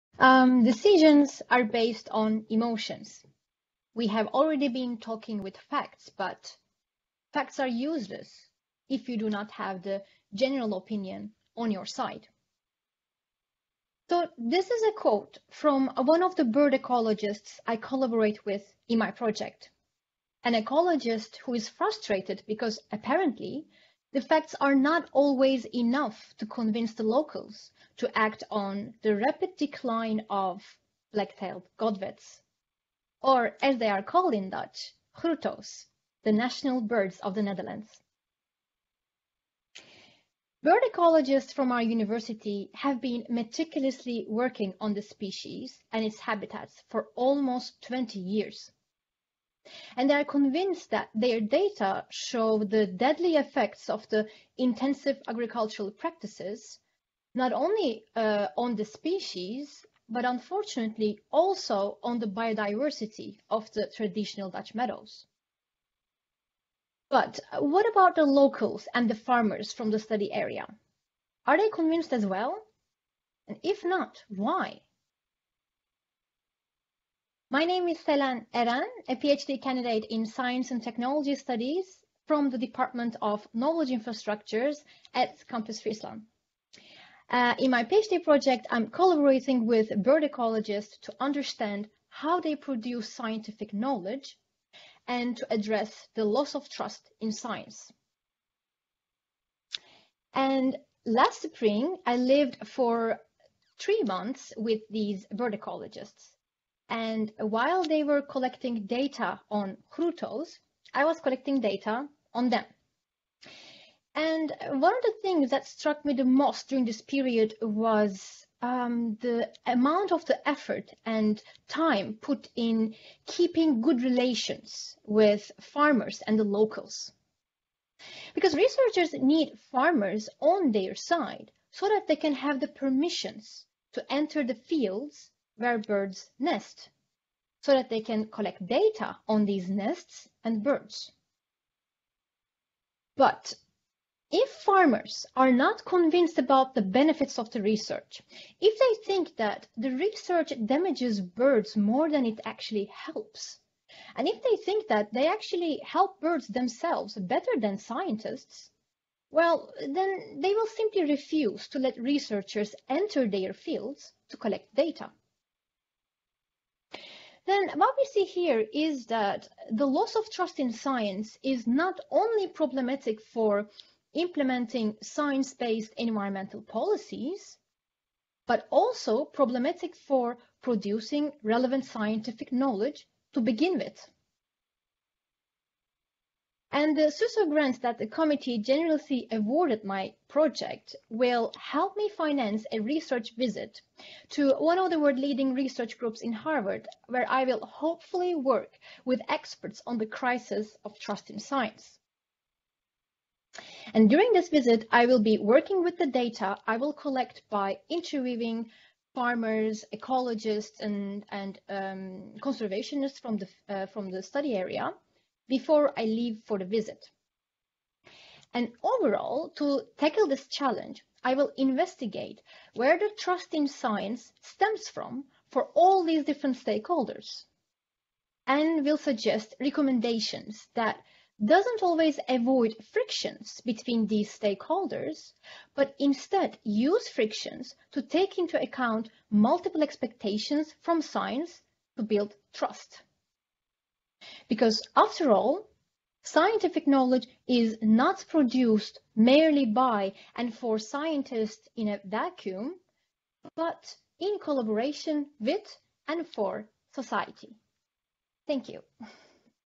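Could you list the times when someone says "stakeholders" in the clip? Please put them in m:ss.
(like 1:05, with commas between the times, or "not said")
3:46, 3:54.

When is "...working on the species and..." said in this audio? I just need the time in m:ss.
0:44.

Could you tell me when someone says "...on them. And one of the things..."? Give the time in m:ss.
1:52.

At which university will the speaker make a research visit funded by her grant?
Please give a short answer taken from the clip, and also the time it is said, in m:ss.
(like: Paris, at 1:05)
Harvard, at 3:16.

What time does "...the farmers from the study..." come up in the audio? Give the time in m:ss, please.
1:09.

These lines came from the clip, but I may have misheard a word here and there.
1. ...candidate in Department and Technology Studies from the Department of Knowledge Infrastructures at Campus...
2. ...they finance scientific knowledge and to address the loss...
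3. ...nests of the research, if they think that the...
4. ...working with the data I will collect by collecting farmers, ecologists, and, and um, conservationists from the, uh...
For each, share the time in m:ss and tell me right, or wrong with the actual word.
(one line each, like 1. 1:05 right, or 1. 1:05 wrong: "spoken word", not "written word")
1. 1:19 wrong: "Science", not "Department"
2. 1:32 wrong: "produce", not "finance"
3. 2:26 wrong: "benefits", not "nests"
4. 3:25 wrong: "interviewing", not "collecting".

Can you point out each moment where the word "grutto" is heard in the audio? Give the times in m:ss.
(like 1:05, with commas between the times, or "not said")
0:35, 1:49.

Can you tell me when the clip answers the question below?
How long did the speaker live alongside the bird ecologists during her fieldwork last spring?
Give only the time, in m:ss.
1:43.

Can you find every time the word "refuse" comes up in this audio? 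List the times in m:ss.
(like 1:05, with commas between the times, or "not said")
2:41.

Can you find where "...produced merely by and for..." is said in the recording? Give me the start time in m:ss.
4:08.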